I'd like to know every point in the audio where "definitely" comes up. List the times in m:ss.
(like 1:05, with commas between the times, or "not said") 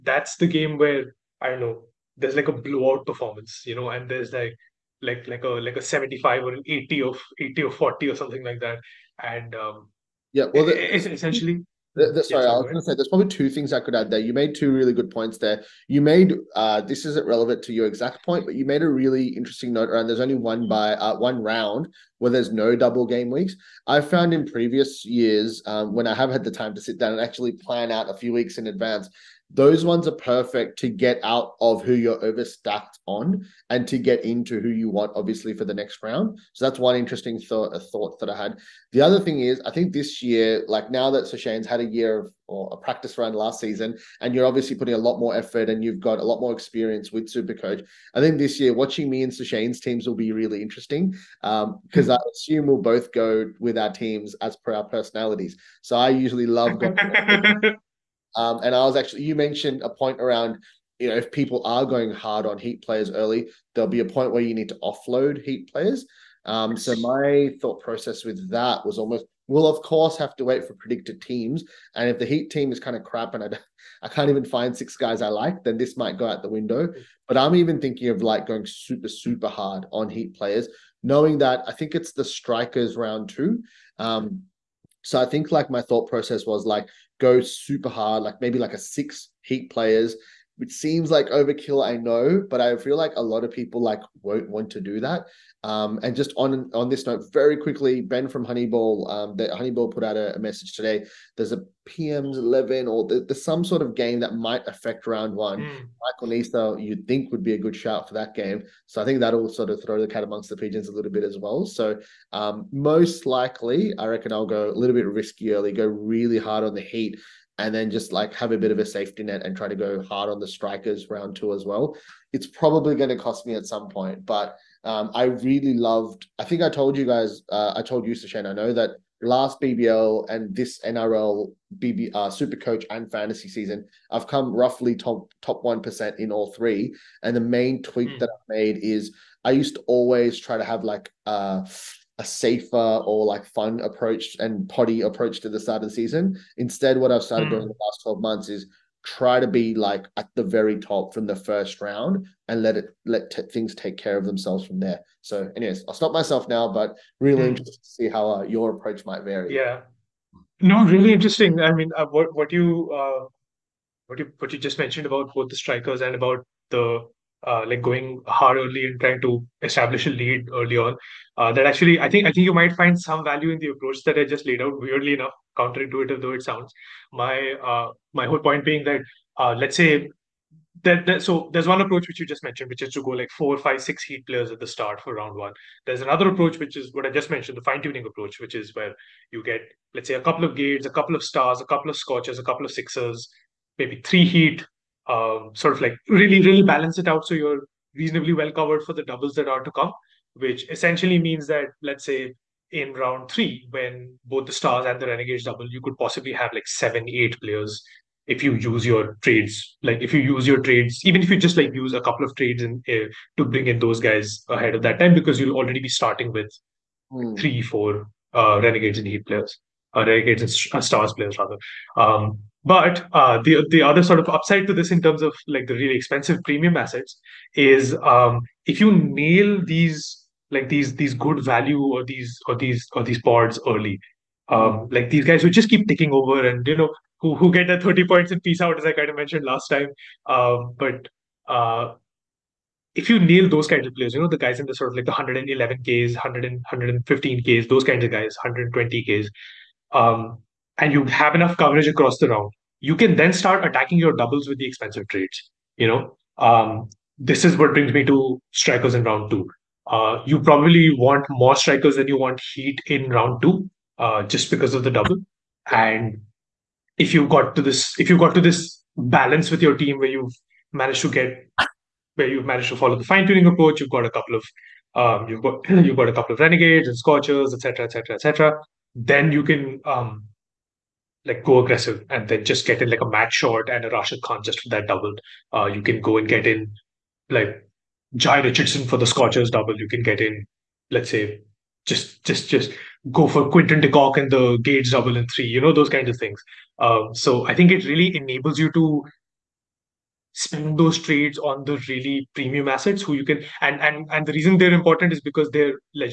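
not said.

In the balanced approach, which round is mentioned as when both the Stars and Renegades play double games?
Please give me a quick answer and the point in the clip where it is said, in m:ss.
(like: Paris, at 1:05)
round 3, at 3:22.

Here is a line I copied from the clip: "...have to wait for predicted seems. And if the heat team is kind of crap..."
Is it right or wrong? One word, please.
wrong.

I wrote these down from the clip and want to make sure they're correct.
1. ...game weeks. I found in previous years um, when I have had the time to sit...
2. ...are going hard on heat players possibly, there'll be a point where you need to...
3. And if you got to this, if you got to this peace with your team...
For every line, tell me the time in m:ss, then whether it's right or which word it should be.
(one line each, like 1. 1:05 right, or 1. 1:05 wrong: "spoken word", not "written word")
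1. 0:23 right
2. 1:01 wrong: "early", not "possibly"
3. 4:25 wrong: "balance", not "peace".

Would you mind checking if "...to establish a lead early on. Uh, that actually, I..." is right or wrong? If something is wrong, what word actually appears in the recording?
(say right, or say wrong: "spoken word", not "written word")
right.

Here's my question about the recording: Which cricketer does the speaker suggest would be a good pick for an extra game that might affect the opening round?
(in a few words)
Michael Neser.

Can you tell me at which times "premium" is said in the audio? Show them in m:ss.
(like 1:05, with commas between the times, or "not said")
3:46, 5:02.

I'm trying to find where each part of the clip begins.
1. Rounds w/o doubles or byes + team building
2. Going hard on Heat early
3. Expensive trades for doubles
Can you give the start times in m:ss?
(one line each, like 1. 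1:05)
1. 0:13
2. 1:17
3. 2:40.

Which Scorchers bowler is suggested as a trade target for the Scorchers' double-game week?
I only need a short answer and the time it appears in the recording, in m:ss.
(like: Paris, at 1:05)
Jhye Richardson, at 4:48.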